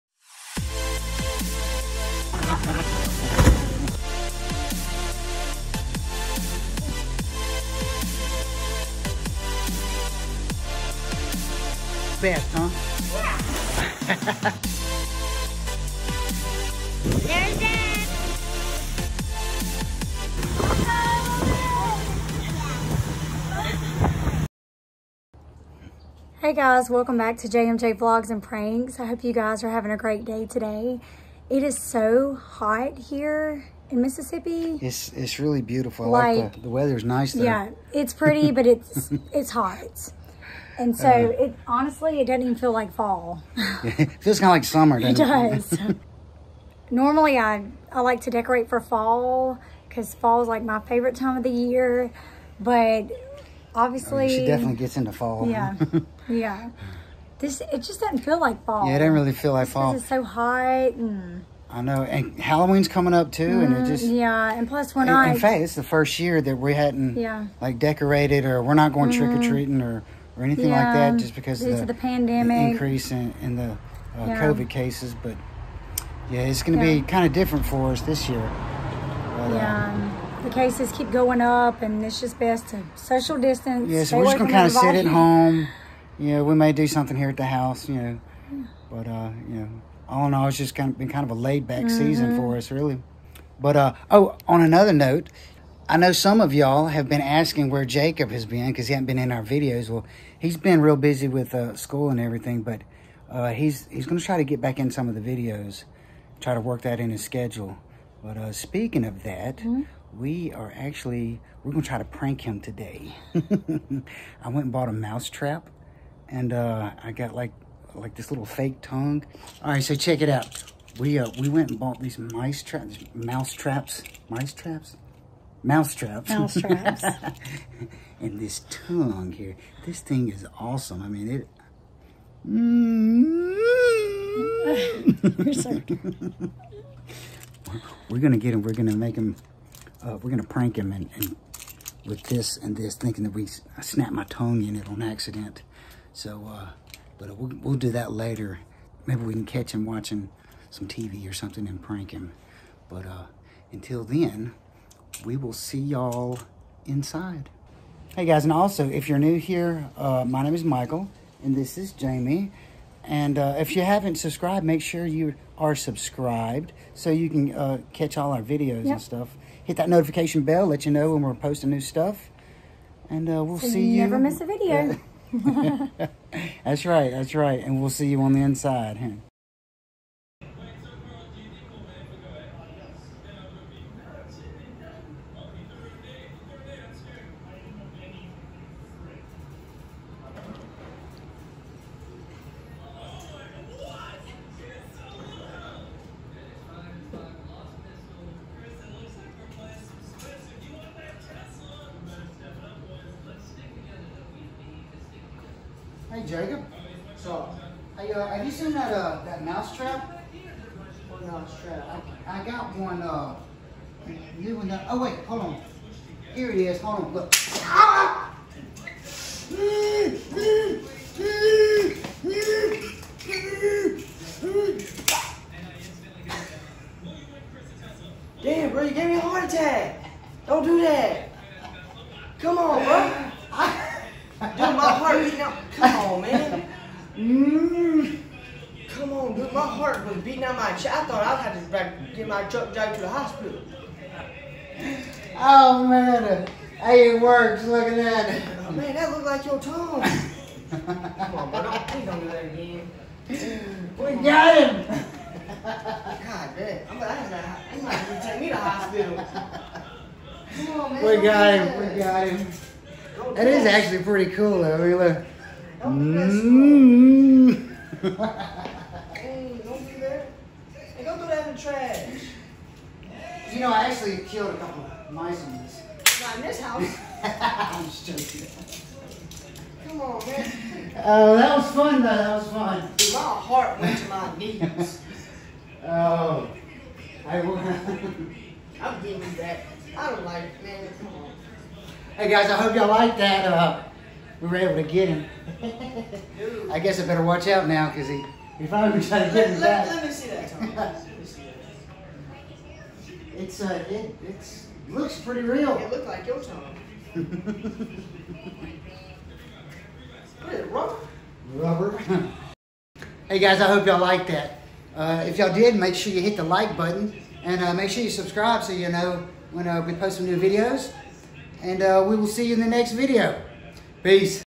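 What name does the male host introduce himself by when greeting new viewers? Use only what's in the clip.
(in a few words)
Michael.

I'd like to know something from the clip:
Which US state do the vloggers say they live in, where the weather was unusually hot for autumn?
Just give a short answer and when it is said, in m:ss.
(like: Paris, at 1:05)
Mississippi, at 0:33.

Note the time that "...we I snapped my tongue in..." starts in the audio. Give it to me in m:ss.
2:23.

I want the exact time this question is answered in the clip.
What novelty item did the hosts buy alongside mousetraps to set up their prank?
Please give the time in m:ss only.
1:58.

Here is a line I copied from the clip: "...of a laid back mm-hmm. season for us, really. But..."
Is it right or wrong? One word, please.
right.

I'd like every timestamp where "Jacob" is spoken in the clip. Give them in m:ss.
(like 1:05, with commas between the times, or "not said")
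1:37, 3:26.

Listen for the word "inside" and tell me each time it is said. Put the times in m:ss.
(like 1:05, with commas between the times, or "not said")
2:36, 2:58.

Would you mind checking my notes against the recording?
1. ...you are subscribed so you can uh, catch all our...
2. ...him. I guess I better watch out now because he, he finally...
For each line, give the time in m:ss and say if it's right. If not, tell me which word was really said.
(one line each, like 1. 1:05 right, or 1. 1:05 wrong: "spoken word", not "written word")
1. 2:45 right
2. 4:55 right.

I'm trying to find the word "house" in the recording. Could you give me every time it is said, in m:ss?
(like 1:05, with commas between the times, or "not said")
1:27, 4:36.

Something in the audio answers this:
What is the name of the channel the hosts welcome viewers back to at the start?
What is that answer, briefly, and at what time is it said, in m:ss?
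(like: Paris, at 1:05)
JMJ Vlogs and Pranks, at 0:27.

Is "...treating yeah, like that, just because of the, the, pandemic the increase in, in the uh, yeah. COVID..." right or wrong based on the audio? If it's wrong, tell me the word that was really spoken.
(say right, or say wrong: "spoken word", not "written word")
wrong: "anything", not "treating".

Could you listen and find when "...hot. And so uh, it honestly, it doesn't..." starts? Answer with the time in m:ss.
0:39.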